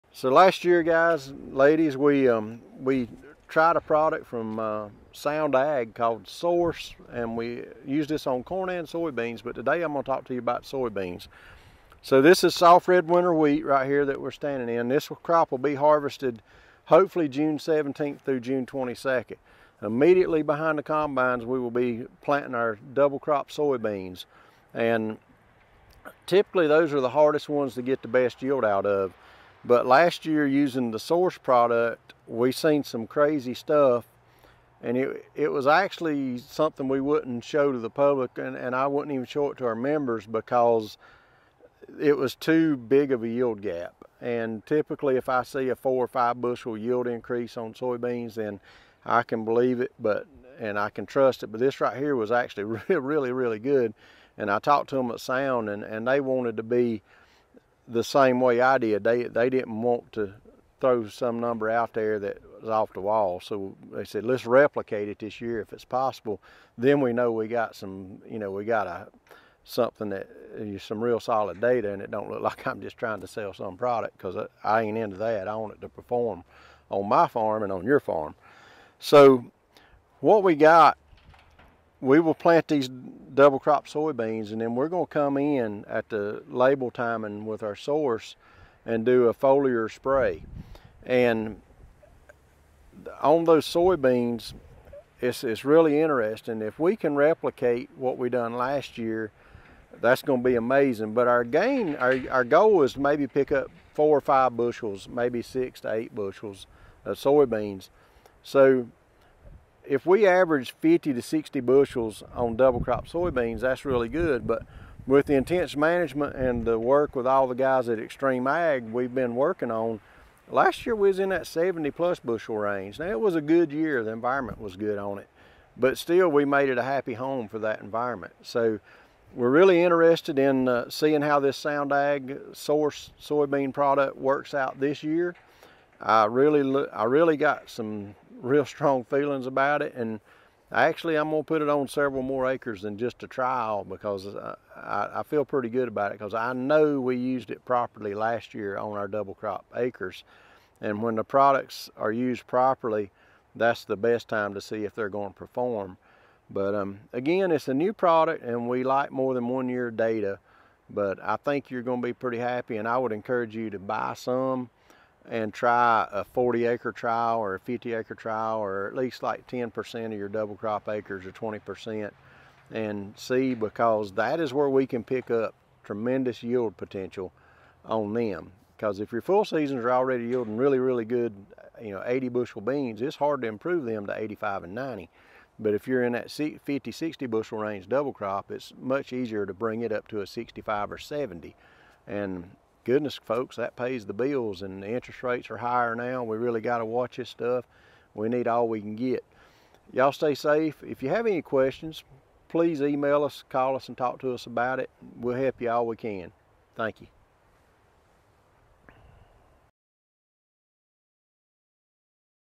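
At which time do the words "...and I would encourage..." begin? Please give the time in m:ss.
2:42.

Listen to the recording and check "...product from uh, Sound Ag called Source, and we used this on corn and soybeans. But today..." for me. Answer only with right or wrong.
right.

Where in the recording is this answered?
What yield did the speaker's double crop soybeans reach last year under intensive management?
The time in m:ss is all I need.
2:01.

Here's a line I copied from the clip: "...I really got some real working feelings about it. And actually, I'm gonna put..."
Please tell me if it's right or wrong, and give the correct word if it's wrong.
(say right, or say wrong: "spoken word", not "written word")
wrong: "strong", not "working".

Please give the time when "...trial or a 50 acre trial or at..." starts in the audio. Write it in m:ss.
2:46.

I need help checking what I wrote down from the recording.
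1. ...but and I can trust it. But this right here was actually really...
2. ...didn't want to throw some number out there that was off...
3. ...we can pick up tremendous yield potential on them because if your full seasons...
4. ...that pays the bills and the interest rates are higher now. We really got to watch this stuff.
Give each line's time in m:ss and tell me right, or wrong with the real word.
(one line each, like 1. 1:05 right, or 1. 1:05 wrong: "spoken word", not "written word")
1. 0:49 right
2. 0:59 right
3. 2:54 right
4. 3:13 right.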